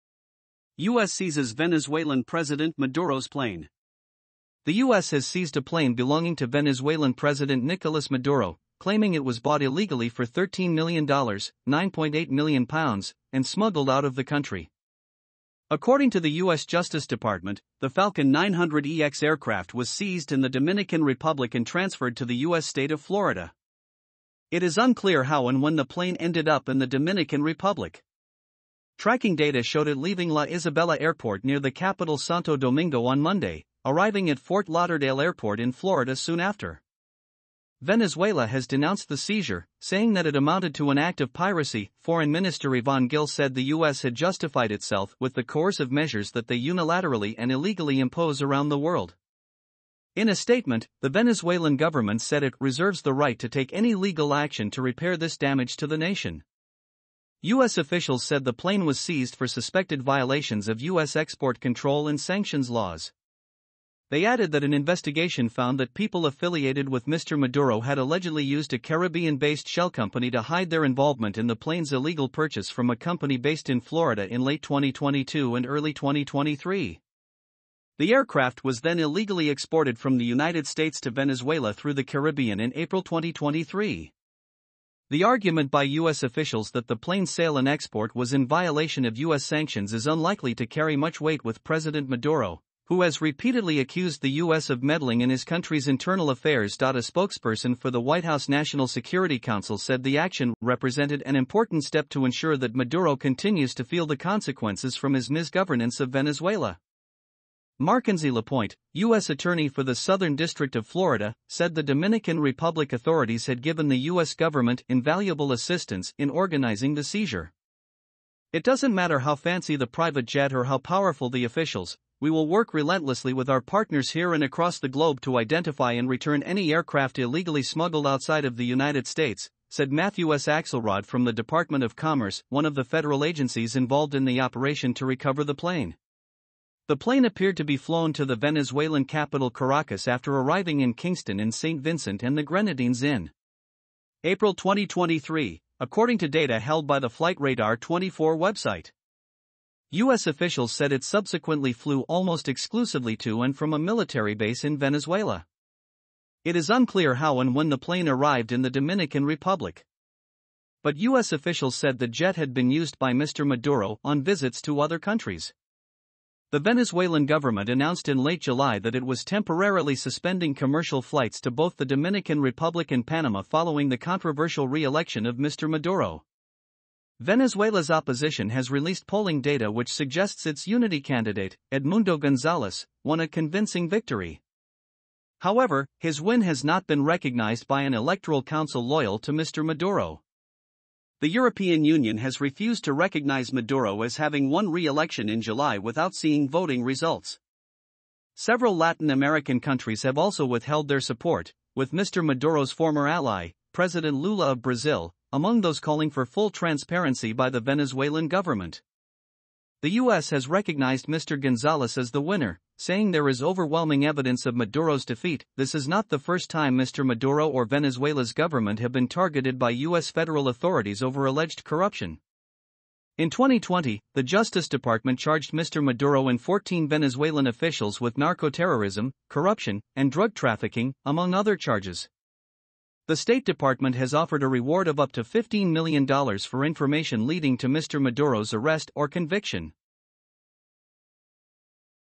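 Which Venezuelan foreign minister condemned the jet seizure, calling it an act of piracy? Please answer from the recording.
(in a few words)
Ivan Gil.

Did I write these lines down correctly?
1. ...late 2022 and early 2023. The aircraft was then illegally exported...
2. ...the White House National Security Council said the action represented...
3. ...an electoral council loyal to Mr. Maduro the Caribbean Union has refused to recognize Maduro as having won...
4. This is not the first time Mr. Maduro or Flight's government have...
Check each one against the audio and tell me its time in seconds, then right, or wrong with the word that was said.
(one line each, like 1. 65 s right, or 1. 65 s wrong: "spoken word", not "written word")
1. 74 s right
2. 97 s right
3. 187 s wrong: "European", not "Caribbean"
4. 215 s wrong: "Venezuela", not "Flight".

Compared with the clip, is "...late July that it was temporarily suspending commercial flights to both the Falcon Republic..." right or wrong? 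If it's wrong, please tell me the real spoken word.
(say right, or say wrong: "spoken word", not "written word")
wrong: "Dominican", not "Falcon".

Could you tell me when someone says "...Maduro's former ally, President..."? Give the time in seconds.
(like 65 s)
202 s.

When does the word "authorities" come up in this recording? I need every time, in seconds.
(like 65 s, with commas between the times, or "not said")
112 s, 220 s.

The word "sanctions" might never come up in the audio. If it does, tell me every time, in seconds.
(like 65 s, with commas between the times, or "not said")
62 s, 89 s.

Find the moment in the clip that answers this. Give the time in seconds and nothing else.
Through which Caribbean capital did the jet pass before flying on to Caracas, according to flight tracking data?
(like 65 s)
140 s.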